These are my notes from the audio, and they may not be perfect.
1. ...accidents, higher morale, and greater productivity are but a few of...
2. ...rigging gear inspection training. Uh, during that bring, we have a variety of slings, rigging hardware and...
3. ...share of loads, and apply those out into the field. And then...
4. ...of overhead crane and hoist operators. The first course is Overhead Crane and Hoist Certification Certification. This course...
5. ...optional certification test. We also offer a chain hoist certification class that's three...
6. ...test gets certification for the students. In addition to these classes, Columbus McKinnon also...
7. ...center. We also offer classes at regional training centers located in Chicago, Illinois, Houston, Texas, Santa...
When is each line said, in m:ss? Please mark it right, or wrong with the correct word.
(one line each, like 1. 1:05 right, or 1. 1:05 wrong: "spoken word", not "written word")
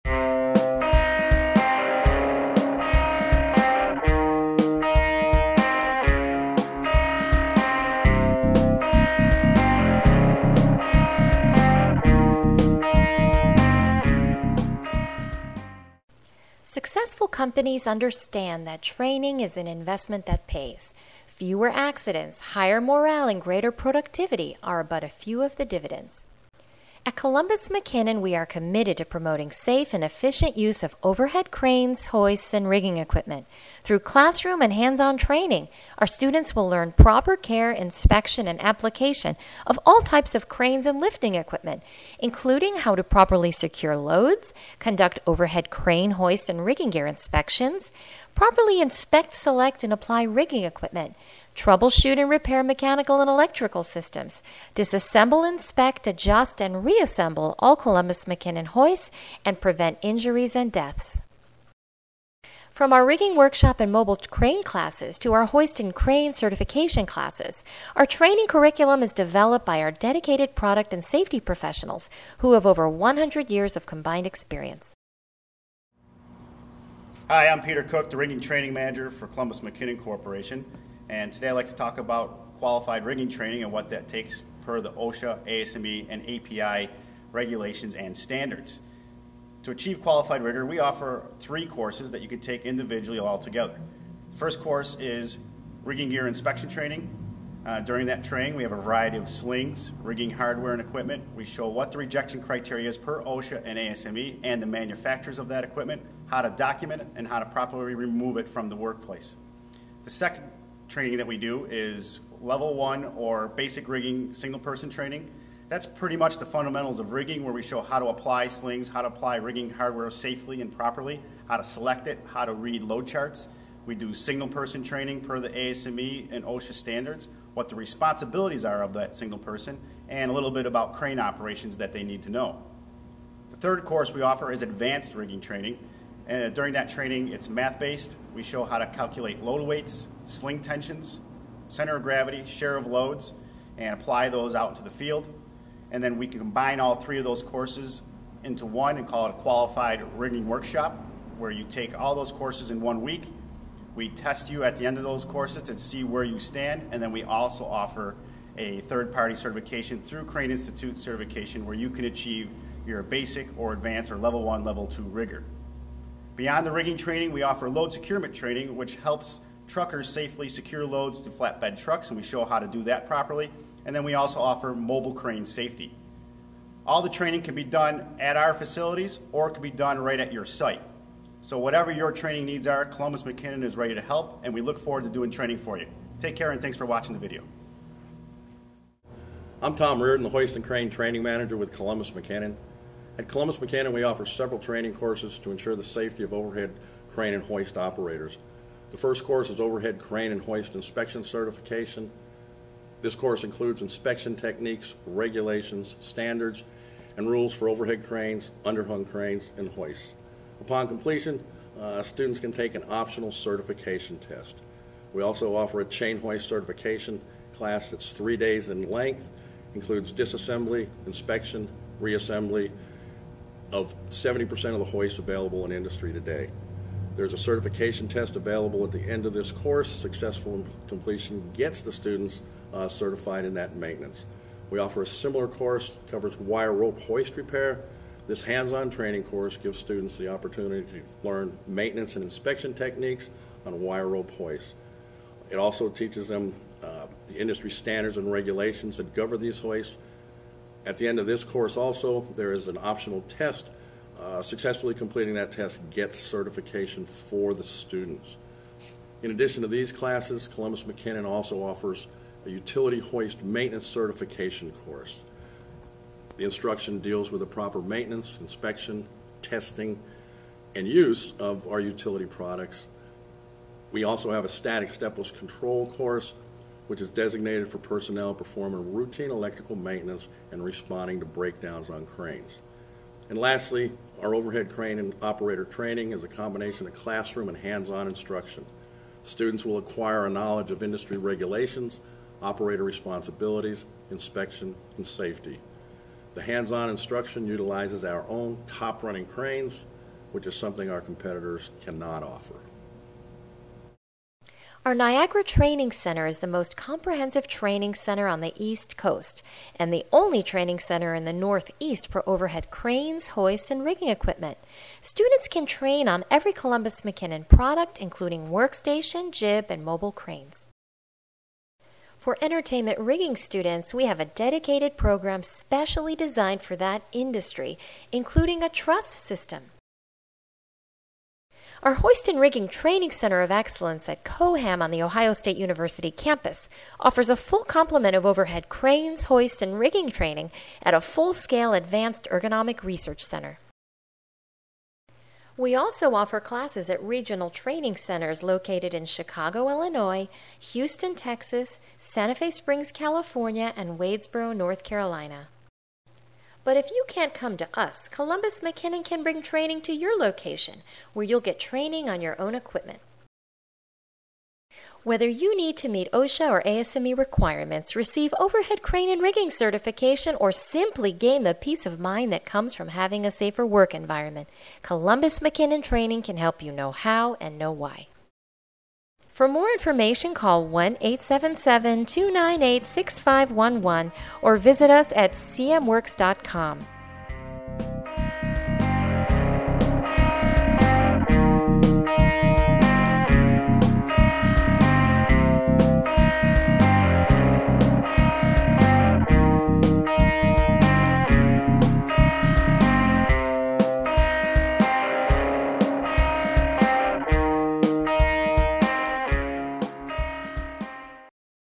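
1. 0:21 right
2. 1:35 wrong: "training", not "bring"
3. 2:22 right
4. 3:16 wrong: "Inspection", not "Certification"
5. 3:32 right
6. 4:15 right
7. 5:43 right.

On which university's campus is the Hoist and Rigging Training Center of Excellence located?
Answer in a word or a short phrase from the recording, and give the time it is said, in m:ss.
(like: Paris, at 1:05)
Ohio State University, at 5:35.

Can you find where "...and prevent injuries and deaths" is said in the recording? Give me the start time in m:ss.
0:59.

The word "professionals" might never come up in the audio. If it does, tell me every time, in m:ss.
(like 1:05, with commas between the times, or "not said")
1:11.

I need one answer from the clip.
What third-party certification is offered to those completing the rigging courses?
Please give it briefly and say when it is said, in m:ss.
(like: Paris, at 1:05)
Crane Institute certification, at 2:40.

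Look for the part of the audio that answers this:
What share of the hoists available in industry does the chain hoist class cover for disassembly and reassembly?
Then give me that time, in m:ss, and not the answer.
3:44.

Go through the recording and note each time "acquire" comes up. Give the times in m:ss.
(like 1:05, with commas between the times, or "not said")
4:49.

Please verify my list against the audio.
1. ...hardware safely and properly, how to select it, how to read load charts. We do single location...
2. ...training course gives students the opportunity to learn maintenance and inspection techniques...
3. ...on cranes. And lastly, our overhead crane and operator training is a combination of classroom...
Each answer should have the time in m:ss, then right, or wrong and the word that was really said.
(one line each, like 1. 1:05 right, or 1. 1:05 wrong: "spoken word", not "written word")
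1. 1:59 wrong: "person", not "location"
2. 3:58 right
3. 4:41 right.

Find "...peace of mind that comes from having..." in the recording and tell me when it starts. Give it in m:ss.
6:11.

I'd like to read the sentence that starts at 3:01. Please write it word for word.
So whatever your training needs are, Columbus McKinnon is ready to help, and we look forward to doing training for you.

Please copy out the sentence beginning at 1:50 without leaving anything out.
The second training that we do is level one or basic rigging single person training.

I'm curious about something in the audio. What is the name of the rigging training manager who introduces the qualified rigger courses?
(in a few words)
Peter Cook.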